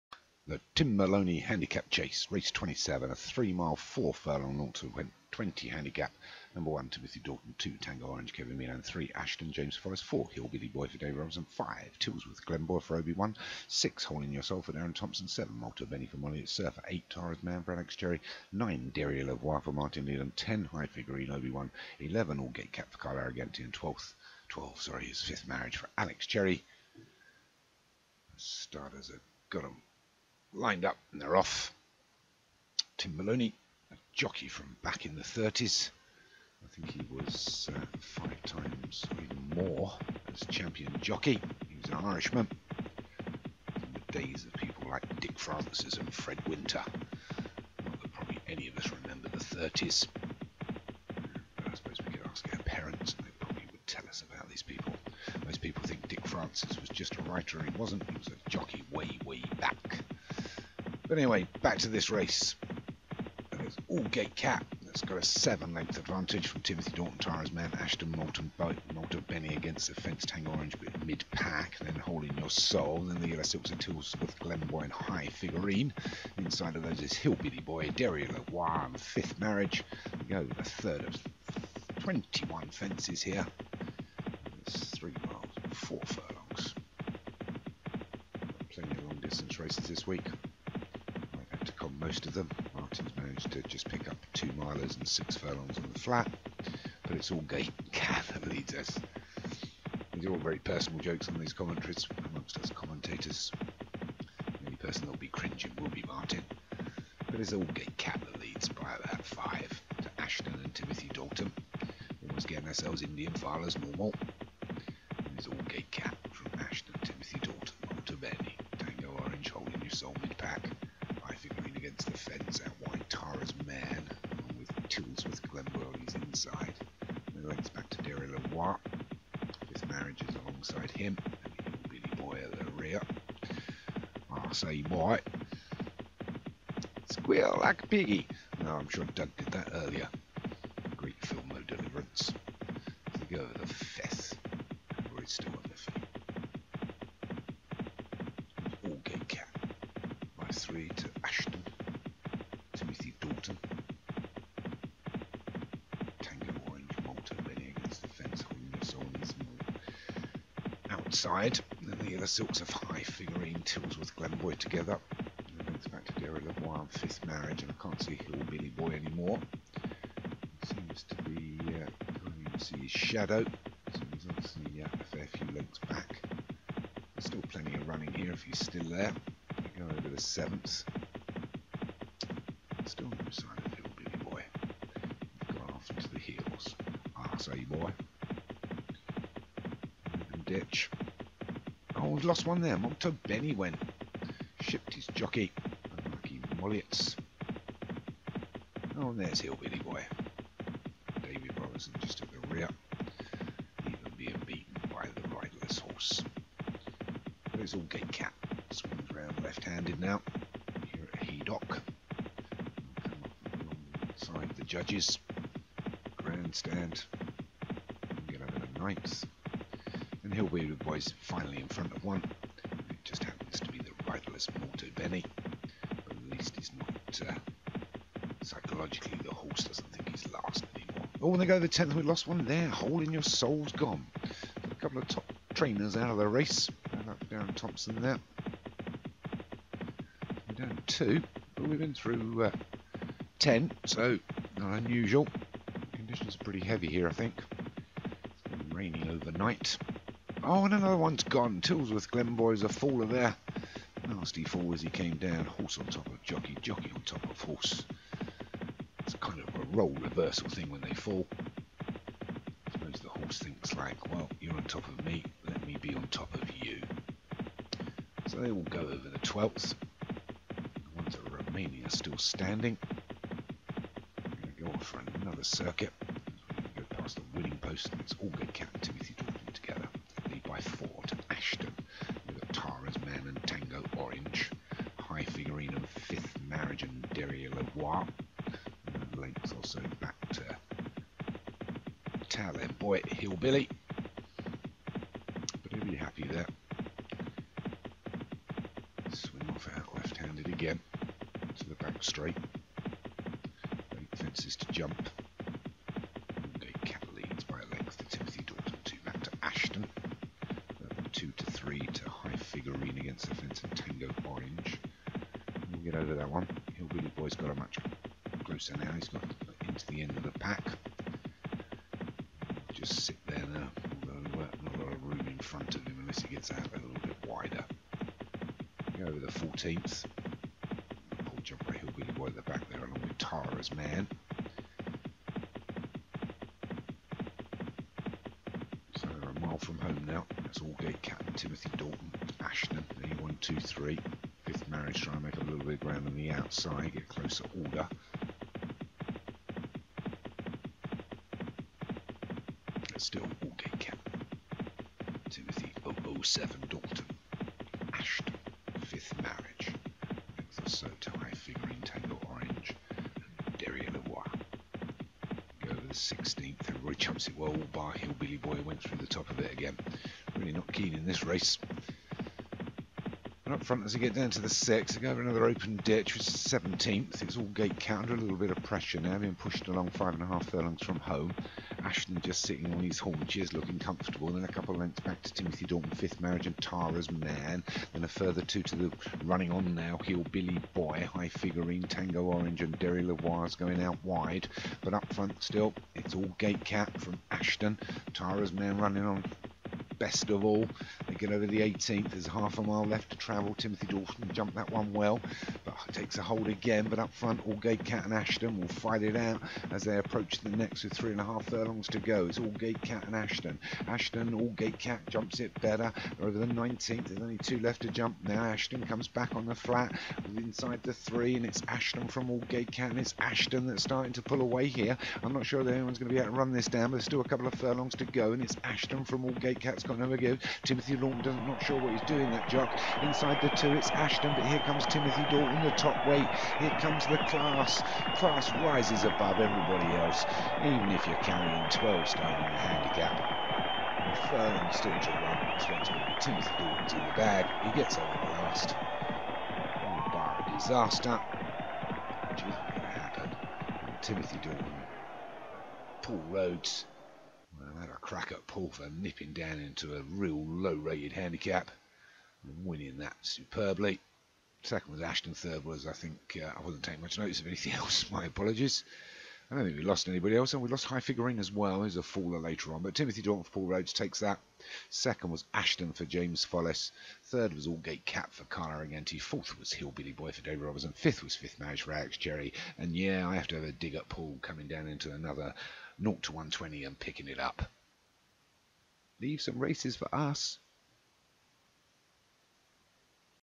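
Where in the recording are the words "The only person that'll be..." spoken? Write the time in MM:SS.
01:43.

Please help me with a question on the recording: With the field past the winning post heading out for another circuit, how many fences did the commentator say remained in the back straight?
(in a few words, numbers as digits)
8.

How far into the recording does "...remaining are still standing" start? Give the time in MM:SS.
04:31.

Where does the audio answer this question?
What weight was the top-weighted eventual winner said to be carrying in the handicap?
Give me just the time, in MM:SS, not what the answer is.
07:21.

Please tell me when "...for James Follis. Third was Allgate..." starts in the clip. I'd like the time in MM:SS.
07:55.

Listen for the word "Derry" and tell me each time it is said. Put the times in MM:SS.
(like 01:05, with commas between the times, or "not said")
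00:18, 01:17, 02:08, 02:46, 06:03, 06:32.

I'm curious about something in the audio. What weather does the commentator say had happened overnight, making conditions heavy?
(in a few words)
Raining.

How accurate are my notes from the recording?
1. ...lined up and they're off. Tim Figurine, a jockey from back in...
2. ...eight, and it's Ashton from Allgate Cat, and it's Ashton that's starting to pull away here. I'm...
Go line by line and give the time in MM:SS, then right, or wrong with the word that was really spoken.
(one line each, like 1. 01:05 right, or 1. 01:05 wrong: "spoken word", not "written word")
1. 00:30 wrong: "Molony", not "Figurine"
2. 07:00 wrong: "three", not "eight".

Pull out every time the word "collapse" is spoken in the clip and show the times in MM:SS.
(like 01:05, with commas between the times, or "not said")
not said.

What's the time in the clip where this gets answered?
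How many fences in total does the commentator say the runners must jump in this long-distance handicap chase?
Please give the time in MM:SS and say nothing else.
01:22.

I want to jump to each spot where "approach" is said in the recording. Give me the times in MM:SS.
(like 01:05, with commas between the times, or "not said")
06:49.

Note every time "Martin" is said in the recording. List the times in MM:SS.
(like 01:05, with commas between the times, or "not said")
00:19, 01:32, 01:46.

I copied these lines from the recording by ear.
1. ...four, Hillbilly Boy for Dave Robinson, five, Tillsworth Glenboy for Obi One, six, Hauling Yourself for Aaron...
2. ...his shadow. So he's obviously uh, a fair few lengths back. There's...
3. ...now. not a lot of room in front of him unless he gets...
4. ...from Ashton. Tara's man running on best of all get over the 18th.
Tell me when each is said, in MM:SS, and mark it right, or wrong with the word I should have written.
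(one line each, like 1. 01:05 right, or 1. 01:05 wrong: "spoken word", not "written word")
1. 00:10 right
2. 02:52 right
3. 05:23 right
4. 06:37 right.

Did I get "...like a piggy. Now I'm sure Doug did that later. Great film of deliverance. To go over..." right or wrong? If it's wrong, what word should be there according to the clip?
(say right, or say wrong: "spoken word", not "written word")
wrong: "earlier", not "later".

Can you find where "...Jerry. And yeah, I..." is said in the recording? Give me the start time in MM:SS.
08:02.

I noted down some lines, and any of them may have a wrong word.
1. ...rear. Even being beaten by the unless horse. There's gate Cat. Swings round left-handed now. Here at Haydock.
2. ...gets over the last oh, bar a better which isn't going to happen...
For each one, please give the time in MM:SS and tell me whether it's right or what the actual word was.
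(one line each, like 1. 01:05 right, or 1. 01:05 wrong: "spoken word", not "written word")
1. 03:22 wrong: "riderless", not "unless"
2. 07:27 wrong: "disaster", not "better".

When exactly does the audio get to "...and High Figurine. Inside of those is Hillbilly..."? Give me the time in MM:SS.
01:14.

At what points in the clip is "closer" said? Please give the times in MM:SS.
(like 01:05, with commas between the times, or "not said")
05:18, 05:47.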